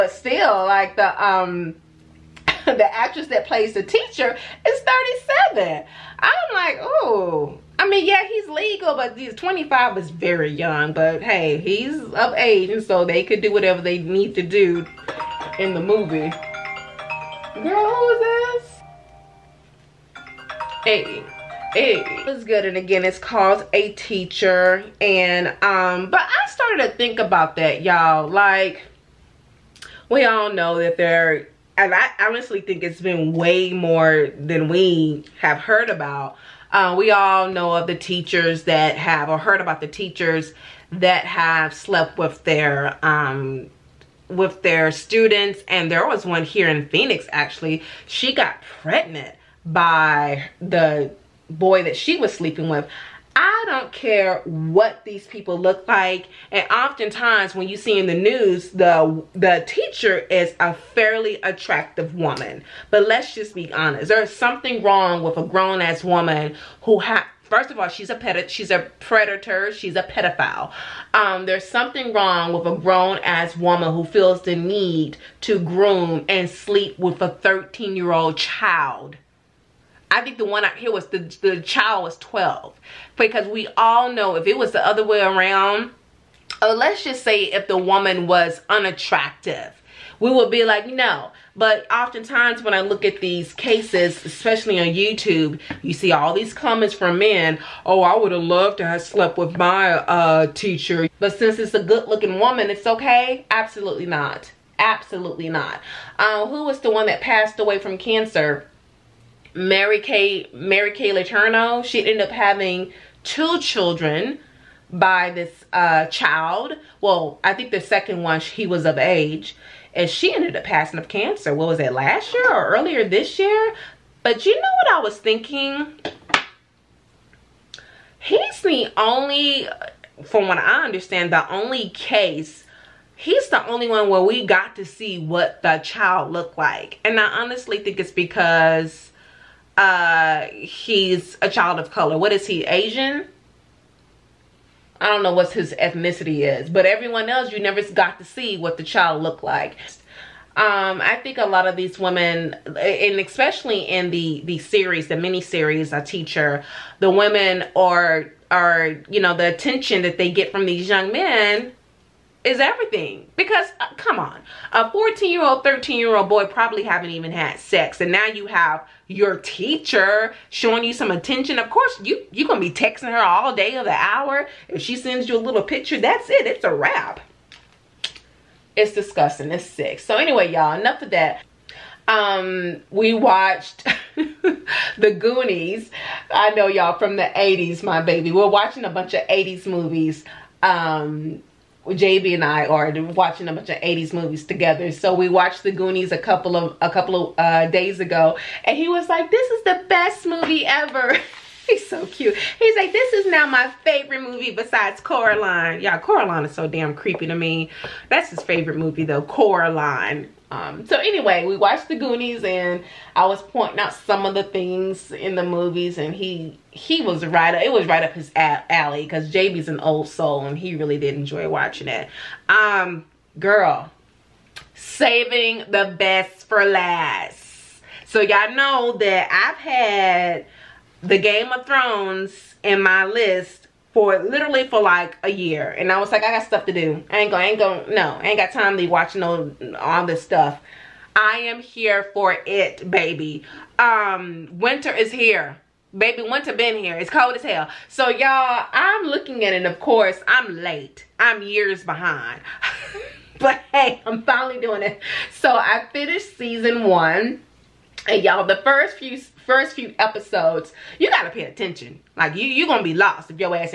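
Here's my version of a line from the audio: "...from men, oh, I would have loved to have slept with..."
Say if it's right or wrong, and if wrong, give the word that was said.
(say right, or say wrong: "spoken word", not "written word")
right.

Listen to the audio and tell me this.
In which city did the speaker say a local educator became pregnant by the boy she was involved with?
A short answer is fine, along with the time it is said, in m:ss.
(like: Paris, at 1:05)
Phoenix, at 0:46.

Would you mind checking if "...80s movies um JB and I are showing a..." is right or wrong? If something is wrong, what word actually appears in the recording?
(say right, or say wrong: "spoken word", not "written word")
wrong: "watching", not "showing".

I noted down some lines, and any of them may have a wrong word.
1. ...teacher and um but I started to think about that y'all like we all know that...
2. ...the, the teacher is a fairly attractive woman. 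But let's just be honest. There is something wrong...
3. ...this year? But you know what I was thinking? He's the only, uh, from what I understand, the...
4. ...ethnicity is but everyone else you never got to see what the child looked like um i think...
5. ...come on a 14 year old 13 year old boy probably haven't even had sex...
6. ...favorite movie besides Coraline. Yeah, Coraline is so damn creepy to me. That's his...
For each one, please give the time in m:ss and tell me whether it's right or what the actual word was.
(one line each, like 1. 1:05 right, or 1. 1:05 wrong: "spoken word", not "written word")
1. 0:23 right
2. 0:58 right
3. 2:03 right
4. 2:25 right
5. 2:43 right
6. 3:23 right.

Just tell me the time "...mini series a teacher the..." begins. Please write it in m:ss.
2:35.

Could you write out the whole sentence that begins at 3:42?
Um, girl, saving the best for last.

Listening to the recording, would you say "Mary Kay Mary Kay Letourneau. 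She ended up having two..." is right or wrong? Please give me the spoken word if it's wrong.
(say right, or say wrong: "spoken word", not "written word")
right.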